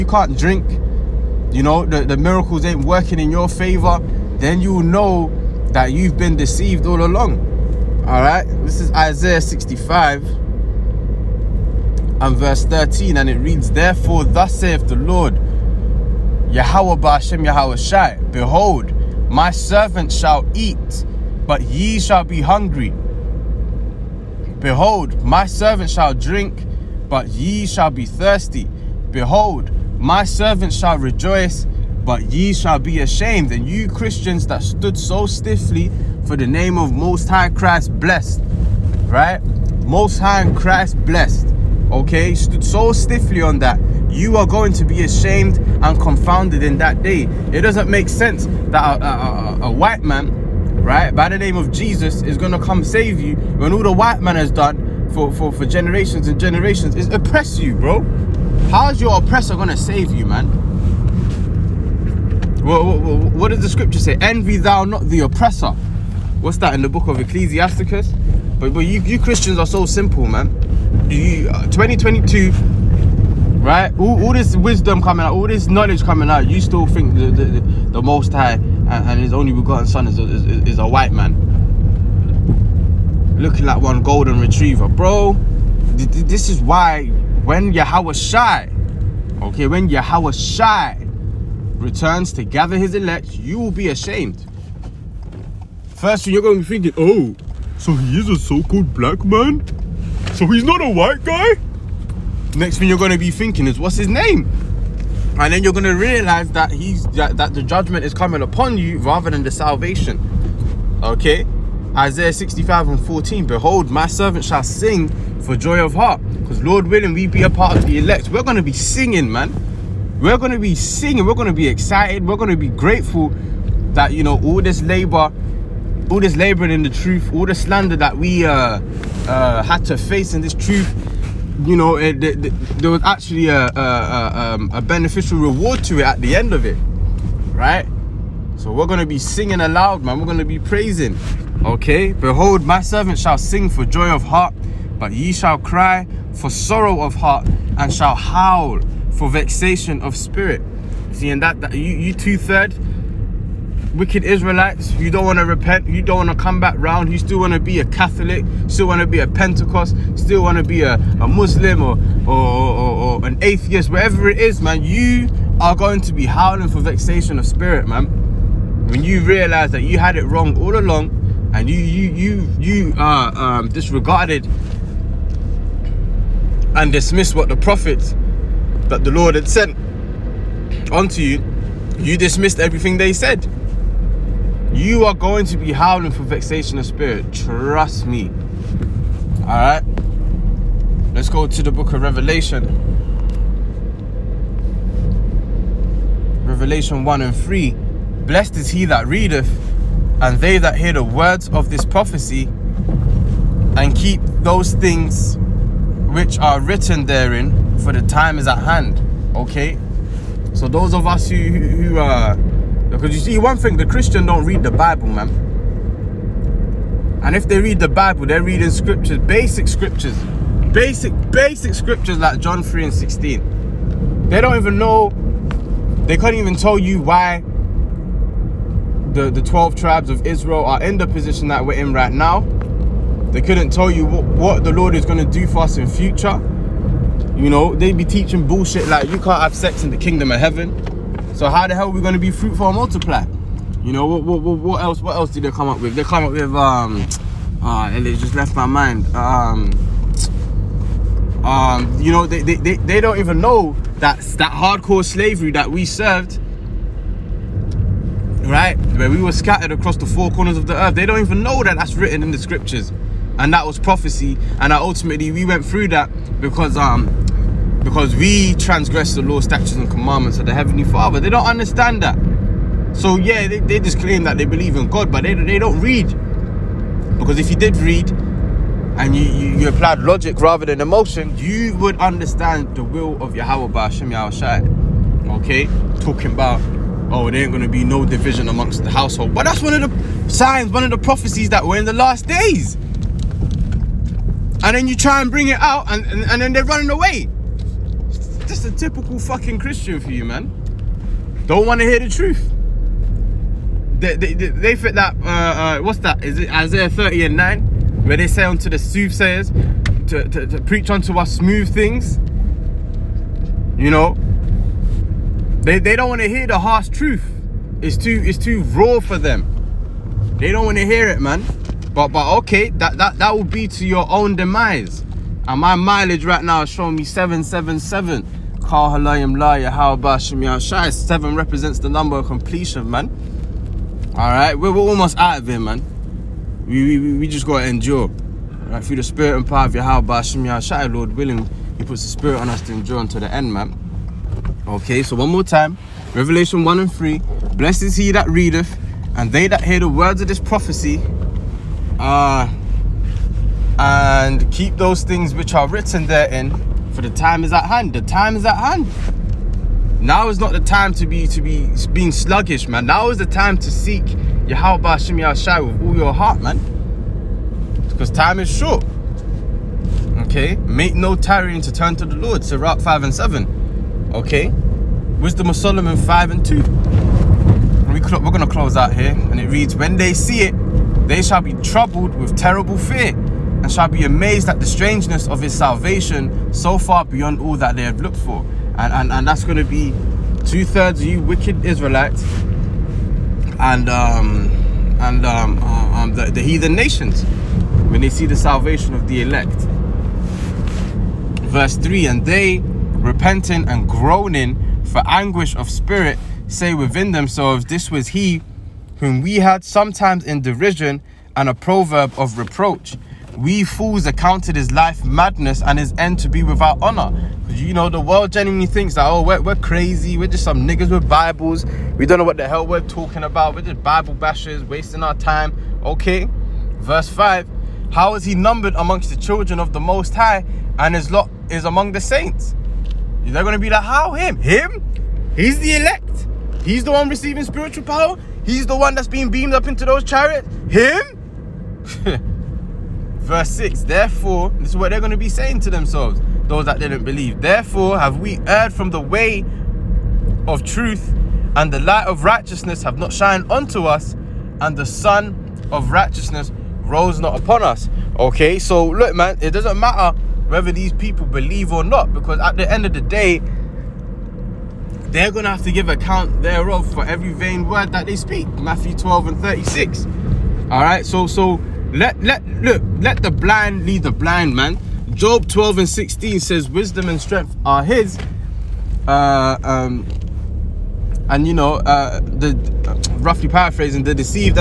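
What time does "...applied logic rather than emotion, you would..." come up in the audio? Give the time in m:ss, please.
4:39.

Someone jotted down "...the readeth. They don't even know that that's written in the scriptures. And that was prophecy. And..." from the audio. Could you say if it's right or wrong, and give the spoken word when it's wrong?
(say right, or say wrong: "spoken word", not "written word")
wrong: "earth", not "readeth".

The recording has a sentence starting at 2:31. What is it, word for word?
See, and that, that you, you two-third, wicked Israelites.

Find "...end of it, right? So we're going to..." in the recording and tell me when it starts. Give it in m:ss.
2:16.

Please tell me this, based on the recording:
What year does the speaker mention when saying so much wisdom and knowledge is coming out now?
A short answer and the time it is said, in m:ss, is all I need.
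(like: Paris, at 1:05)
2022, at 1:11.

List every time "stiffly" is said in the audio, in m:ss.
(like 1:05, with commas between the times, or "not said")
0:35, 0:42.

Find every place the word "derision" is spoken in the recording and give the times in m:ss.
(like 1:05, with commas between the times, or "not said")
6:50.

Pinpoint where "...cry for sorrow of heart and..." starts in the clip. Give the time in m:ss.
2:25.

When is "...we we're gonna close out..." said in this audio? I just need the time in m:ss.
6:17.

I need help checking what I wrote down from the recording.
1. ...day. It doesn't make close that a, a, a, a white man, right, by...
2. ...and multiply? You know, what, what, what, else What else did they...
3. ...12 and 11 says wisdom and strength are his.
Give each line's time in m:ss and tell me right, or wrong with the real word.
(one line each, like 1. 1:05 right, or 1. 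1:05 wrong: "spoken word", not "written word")
1. 0:47 wrong: "sense", not "close"
2. 4:02 right
3. 7:55 wrong: "16", not "11".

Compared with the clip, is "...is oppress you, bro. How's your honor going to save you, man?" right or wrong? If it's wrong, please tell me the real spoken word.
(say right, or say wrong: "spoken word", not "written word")
wrong: "oppressor", not "honor".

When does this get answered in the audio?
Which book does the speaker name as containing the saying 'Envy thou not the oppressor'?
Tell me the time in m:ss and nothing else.
1:07.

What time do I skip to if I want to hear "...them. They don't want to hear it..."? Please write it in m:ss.
5:19.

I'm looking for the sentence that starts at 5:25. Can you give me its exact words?
And my mileage right now is showing me 777.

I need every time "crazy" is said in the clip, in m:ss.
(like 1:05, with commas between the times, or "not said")
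6:59.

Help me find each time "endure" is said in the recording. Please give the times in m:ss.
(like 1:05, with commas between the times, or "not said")
5:37, 5:42.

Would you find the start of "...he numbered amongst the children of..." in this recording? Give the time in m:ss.
7:08.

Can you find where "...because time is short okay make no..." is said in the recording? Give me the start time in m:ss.
6:07.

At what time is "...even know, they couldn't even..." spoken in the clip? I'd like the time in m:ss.
3:44.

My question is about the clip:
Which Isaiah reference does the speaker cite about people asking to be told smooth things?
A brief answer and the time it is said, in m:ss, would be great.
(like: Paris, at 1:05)
Isaiah 30:9, at 5:06.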